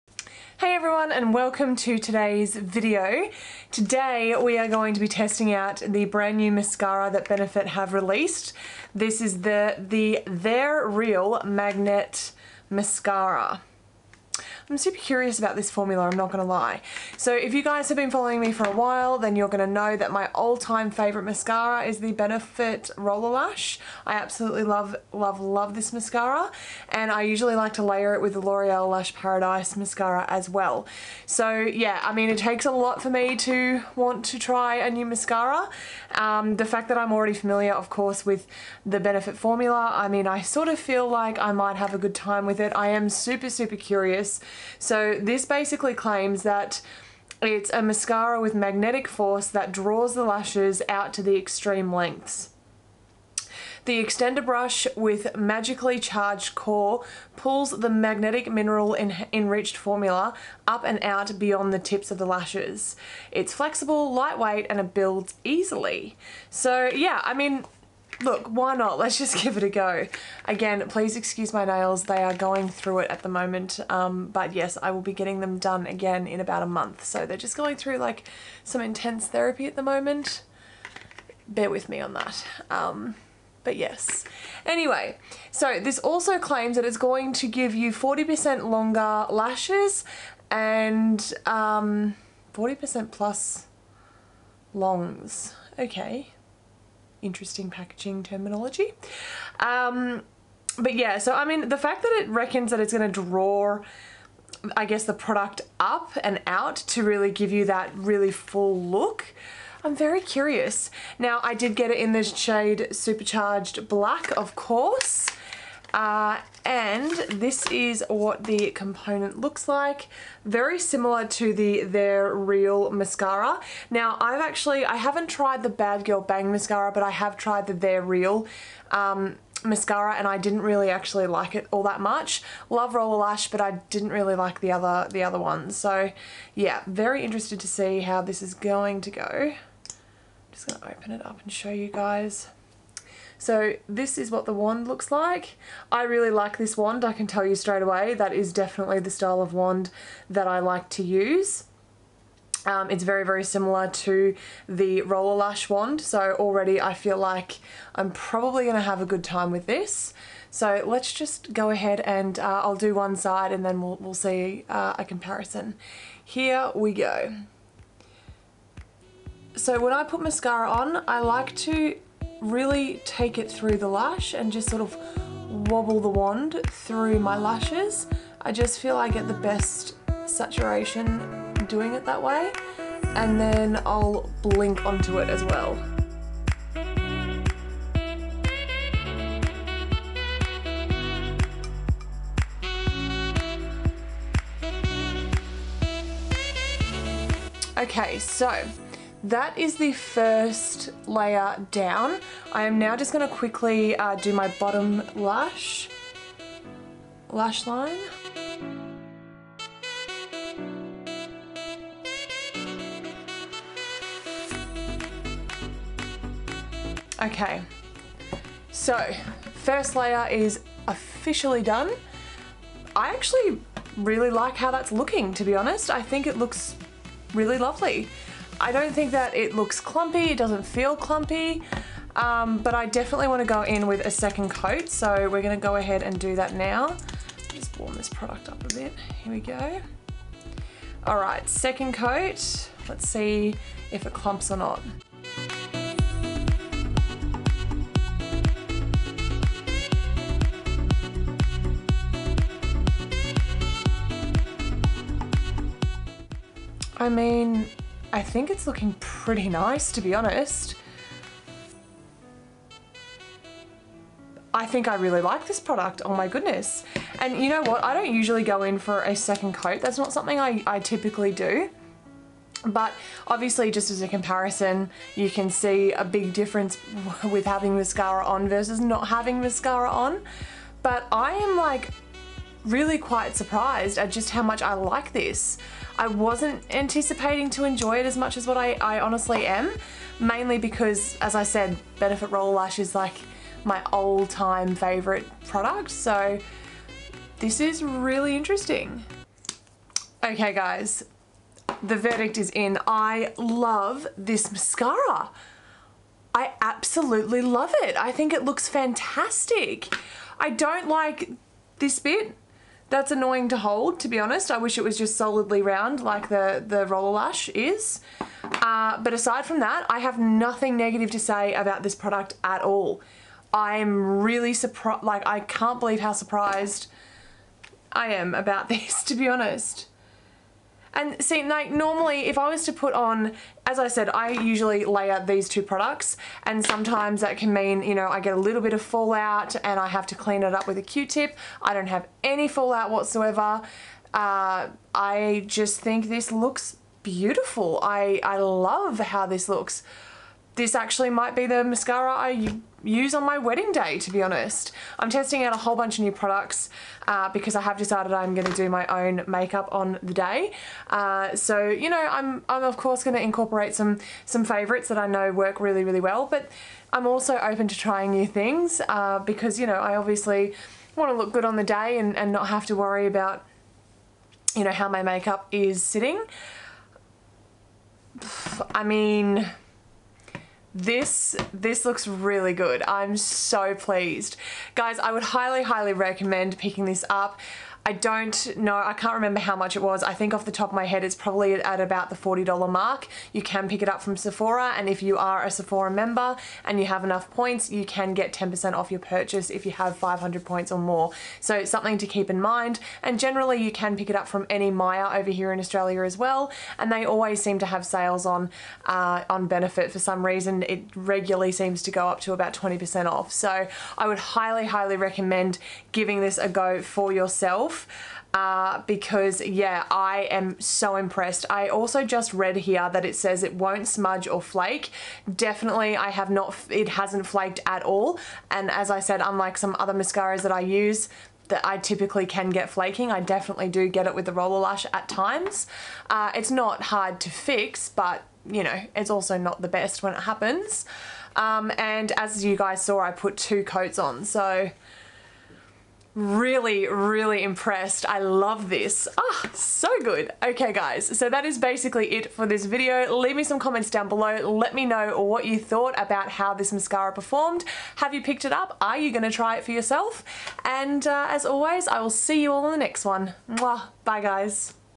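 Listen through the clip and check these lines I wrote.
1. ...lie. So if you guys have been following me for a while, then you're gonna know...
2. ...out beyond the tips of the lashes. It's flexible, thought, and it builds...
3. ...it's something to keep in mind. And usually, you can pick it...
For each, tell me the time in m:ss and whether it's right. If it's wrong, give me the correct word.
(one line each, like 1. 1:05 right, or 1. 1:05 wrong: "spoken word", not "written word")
1. 0:16 right
2. 1:01 wrong: "lightweight", not "thought"
3. 6:41 wrong: "generally", not "usually".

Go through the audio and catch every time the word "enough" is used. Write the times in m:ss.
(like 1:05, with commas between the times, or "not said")
6:37.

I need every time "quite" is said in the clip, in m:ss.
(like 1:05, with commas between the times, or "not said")
4:42.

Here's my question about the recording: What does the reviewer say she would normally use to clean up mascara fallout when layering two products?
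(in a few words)
Q-tip.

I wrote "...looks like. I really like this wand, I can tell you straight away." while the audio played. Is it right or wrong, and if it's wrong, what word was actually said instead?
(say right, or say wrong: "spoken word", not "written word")
right.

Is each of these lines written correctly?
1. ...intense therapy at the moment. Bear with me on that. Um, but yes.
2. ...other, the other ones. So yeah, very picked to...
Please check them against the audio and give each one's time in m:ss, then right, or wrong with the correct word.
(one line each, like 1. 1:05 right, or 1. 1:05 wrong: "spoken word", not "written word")
1. 1:18 right
2. 2:14 wrong: "interested", not "picked".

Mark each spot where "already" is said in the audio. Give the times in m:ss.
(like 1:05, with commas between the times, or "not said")
0:37, 2:36.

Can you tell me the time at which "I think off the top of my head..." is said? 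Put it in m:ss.
6:30.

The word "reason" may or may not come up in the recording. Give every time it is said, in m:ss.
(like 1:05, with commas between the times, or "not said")
6:50.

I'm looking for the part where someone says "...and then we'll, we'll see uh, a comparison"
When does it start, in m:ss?
2:43.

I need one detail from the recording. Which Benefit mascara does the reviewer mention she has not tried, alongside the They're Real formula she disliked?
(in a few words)
Bad Girl Bang.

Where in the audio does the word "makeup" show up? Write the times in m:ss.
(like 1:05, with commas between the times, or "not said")
5:59, 6:15.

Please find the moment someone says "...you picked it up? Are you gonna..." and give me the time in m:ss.
7:38.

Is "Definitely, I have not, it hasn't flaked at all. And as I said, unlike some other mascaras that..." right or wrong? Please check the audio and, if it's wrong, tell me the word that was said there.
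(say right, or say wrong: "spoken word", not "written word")
right.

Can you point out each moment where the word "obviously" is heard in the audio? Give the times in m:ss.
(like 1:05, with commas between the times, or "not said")
4:33, 6:09.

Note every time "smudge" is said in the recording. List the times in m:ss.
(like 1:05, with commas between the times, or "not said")
7:03.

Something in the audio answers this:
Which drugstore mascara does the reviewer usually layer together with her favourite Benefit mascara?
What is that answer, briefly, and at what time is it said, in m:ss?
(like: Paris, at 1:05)
L'Oreal Lash Paradise, at 0:28.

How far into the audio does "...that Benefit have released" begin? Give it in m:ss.
0:07.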